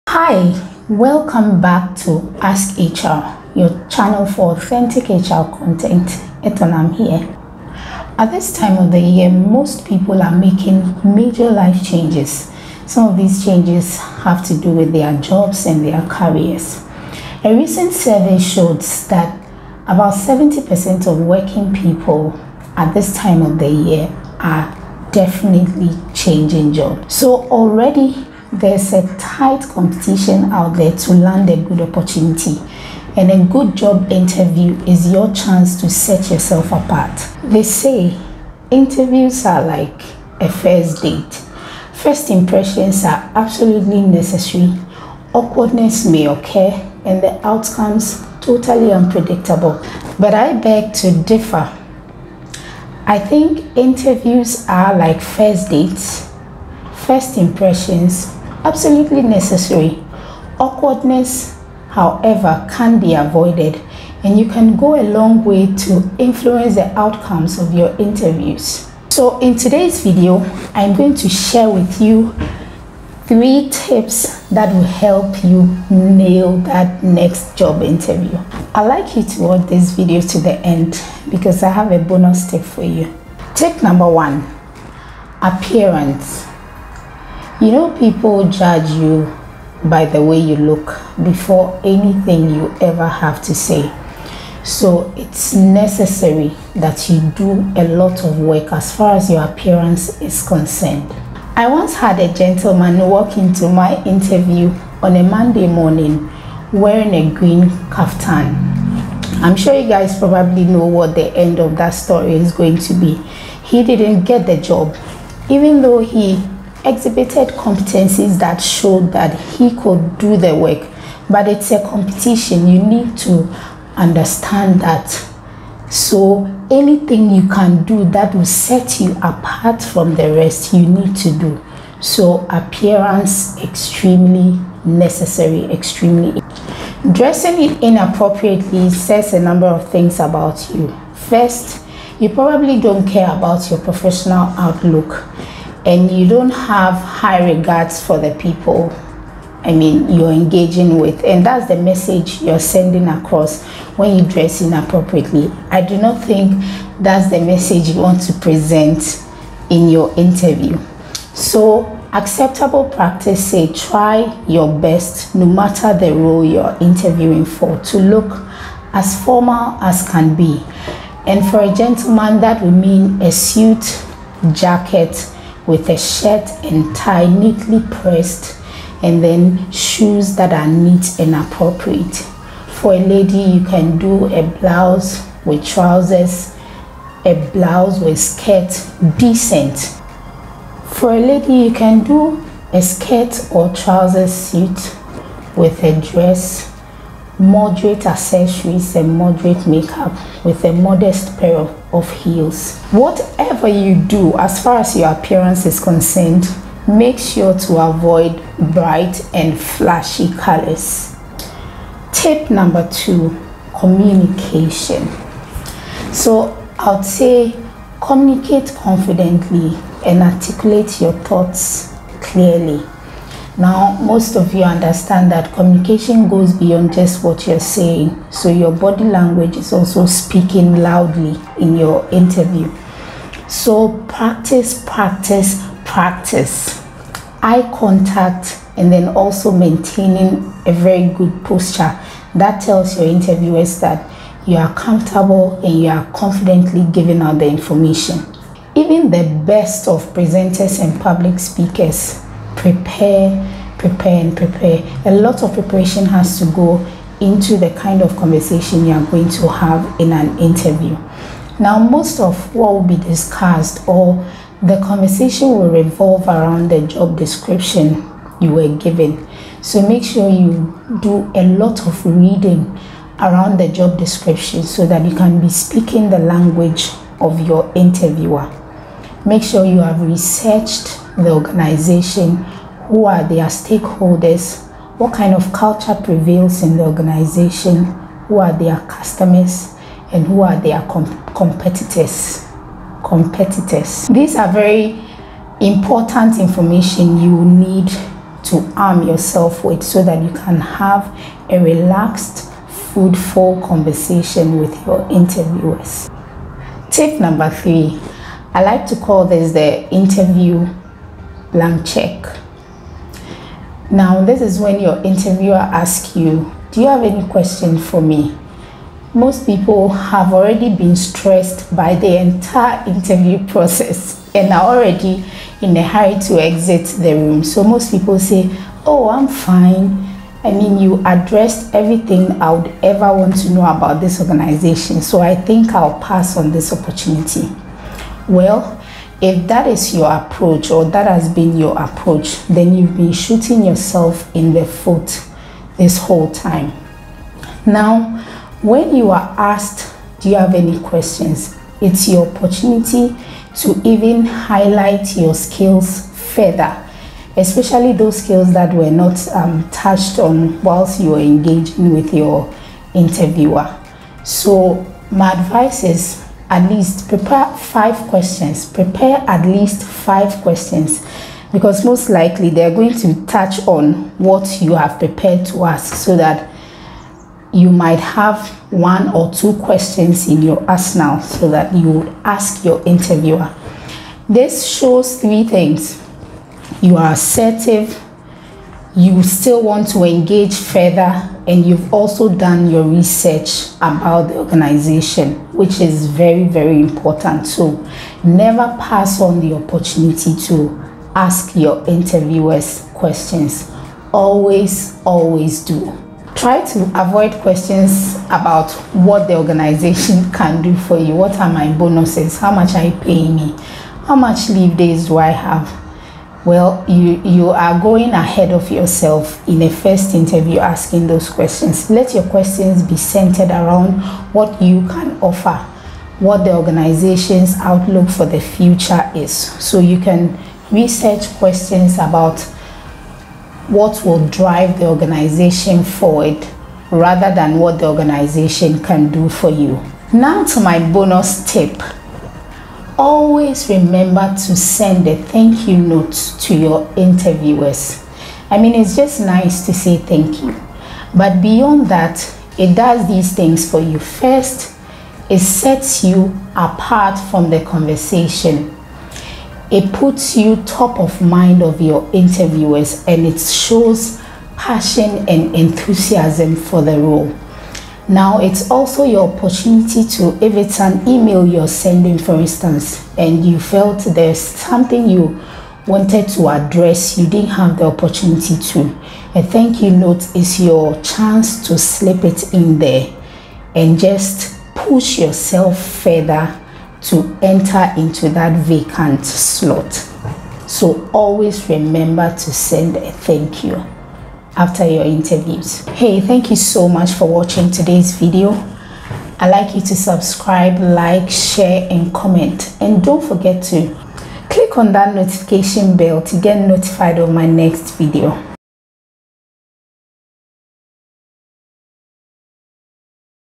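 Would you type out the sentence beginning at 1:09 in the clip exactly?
So in today's video, I'm going to share with you three tips that will help you nail that next job interview.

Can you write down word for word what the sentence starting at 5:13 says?
Now, this is when your interviewer asks you, Do you have any question for me?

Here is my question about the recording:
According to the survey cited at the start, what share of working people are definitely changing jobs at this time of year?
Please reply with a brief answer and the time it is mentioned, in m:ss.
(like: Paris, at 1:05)
70%, at 0:20.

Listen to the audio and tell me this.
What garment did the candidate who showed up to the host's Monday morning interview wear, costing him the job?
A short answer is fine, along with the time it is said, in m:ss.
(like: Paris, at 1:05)
A green kaftan, at 1:47.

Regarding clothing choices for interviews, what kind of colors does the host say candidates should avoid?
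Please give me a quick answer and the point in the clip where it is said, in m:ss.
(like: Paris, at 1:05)
Bright and flashy colors, at 3:28.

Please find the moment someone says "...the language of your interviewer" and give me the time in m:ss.
4:36.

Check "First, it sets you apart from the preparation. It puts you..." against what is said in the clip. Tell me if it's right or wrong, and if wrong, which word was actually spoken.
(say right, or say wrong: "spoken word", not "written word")
wrong: "conversation", not "preparation".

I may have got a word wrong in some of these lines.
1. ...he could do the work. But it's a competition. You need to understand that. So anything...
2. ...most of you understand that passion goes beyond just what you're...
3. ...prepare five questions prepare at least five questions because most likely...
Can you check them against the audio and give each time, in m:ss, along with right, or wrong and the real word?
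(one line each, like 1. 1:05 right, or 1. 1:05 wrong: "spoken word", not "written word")
1. 1:59 right
2. 3:44 wrong: "communication", not "passion"
3. 6:07 right.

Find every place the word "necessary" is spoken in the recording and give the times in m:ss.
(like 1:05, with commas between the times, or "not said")
0:44, 0:59, 1:35, 2:14.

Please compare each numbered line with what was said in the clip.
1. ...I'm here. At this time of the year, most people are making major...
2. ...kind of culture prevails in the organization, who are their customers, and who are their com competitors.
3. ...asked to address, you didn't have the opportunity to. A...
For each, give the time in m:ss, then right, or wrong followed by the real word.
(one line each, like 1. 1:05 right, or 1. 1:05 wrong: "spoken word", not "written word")
1. 0:06 right
2. 4:45 right
3. 7:55 wrong: "wanted", not "asked".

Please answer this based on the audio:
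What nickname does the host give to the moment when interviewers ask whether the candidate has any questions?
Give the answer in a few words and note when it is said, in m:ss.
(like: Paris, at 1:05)
The interview blank check, at 5:09.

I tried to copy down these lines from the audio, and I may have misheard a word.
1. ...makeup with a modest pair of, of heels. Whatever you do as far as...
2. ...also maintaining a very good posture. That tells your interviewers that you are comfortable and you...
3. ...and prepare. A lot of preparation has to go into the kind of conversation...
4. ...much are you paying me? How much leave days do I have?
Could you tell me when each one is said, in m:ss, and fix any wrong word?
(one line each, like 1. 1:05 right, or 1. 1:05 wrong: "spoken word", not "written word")
1. 3:19 right
2. 3:59 right
3. 4:14 right
4. 6:52 right.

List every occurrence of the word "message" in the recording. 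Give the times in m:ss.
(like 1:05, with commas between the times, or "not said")
2:31, 2:37.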